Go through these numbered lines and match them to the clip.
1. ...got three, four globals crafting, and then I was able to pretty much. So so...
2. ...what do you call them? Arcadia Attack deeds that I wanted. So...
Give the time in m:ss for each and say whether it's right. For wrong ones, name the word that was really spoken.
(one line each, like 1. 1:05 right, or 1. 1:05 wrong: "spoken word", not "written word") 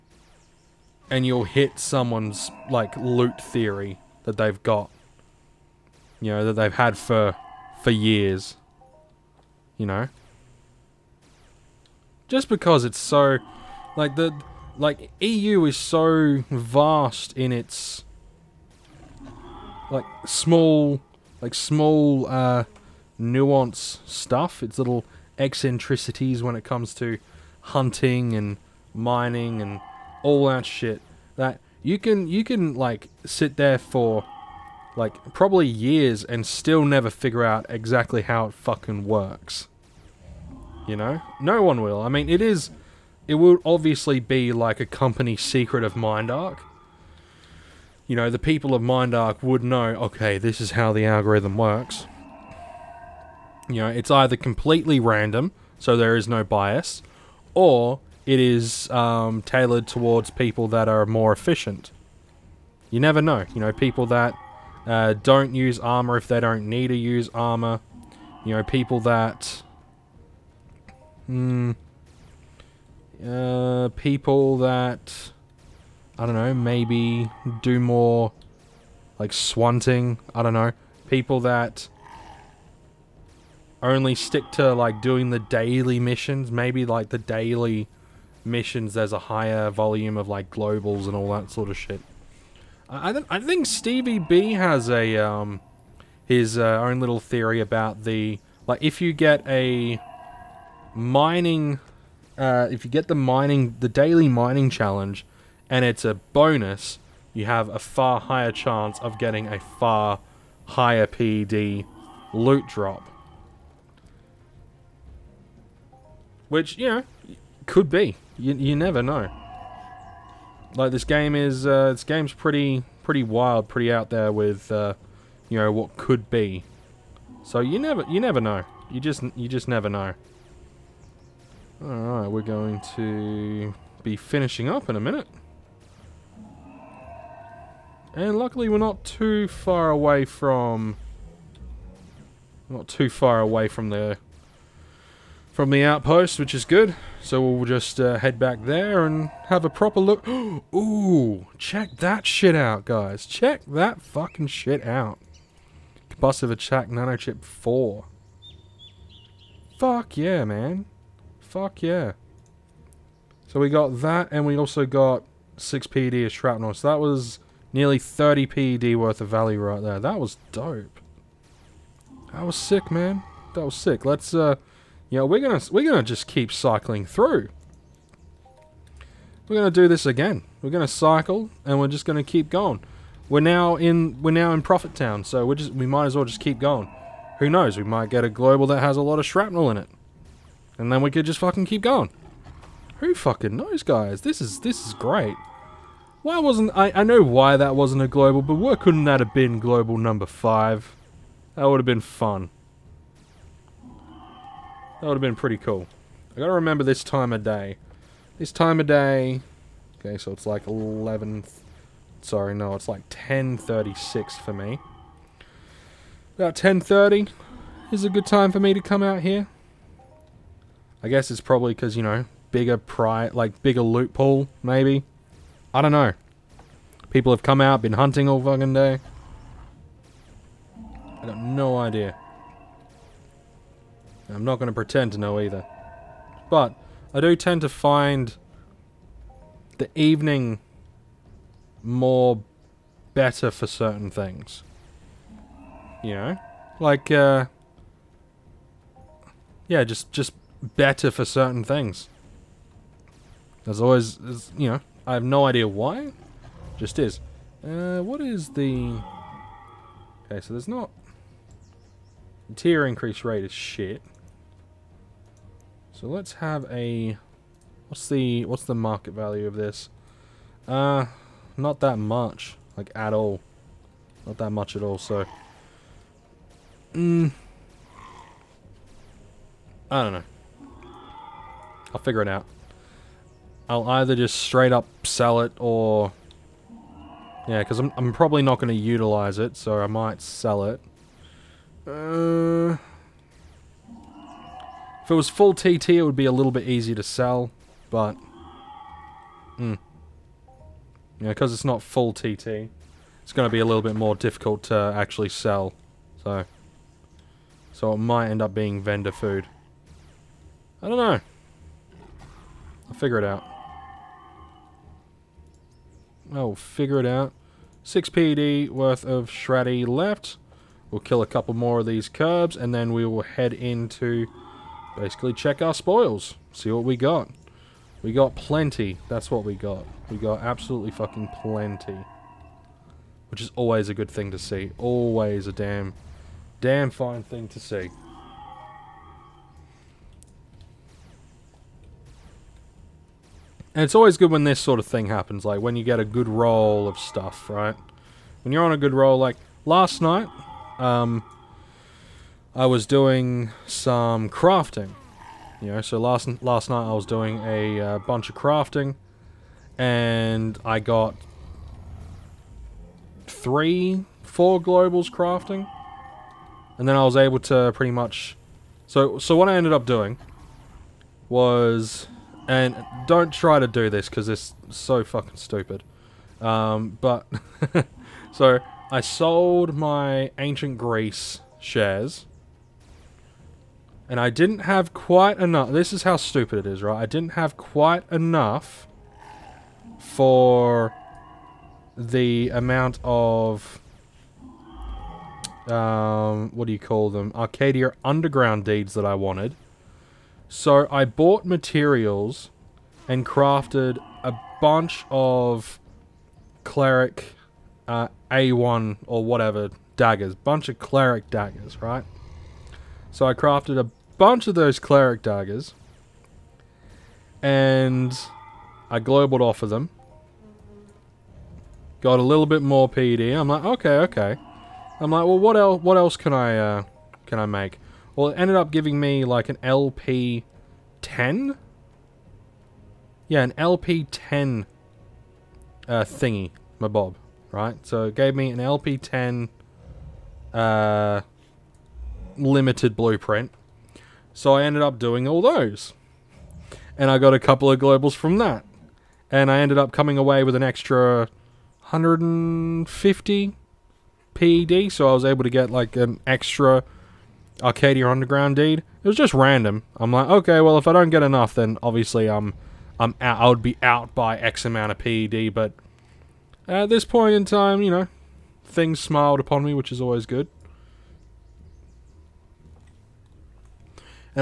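1. 6:00 right
2. 6:36 wrong: "Underground", not "Attack".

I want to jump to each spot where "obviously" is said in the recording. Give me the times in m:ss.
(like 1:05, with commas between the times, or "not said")
0:43, 7:41.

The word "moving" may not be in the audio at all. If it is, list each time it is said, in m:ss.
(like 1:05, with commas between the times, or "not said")
not said.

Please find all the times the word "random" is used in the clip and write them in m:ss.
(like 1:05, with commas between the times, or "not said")
0:54, 7:39.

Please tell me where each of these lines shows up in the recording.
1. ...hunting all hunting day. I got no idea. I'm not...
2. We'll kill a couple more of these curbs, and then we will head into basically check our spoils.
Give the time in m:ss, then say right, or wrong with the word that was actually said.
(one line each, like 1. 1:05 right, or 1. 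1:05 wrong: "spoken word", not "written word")
1. 3:47 wrong: "fucking", not "hunting"
2. 5:20 right.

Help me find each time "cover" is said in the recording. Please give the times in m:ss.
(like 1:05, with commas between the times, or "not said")
not said.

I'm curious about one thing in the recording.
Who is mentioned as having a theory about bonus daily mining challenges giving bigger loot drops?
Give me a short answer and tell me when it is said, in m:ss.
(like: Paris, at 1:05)
Stevie B, at 1:33.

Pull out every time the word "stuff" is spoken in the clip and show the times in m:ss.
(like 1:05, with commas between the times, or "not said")
0:24, 5:46.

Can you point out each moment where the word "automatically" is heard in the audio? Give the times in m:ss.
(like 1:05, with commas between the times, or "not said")
not said.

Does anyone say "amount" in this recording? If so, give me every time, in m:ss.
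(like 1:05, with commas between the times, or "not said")
6:32, 7:44.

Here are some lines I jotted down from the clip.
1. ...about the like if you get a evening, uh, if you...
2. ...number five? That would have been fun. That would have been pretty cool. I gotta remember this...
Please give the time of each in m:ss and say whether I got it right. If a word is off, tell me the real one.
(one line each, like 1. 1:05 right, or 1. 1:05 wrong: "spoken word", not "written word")
1. 1:37 wrong: "mining", not "evening"
2. 3:19 right.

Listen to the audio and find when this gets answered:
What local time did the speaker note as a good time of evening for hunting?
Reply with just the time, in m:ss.
3:33.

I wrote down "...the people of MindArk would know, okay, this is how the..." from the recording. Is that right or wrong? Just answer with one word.
right.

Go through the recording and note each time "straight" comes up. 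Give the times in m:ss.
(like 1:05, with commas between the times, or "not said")
4:44.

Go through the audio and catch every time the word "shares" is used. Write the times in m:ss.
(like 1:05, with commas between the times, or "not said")
6:21.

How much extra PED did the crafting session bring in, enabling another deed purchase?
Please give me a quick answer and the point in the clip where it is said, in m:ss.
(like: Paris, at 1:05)
150 PED, at 7:31.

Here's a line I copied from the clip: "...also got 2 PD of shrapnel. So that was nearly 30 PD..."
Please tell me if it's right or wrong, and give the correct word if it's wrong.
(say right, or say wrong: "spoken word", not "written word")
wrong: "6", not "2".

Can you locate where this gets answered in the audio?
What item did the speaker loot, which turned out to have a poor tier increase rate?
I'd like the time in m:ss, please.
2:36.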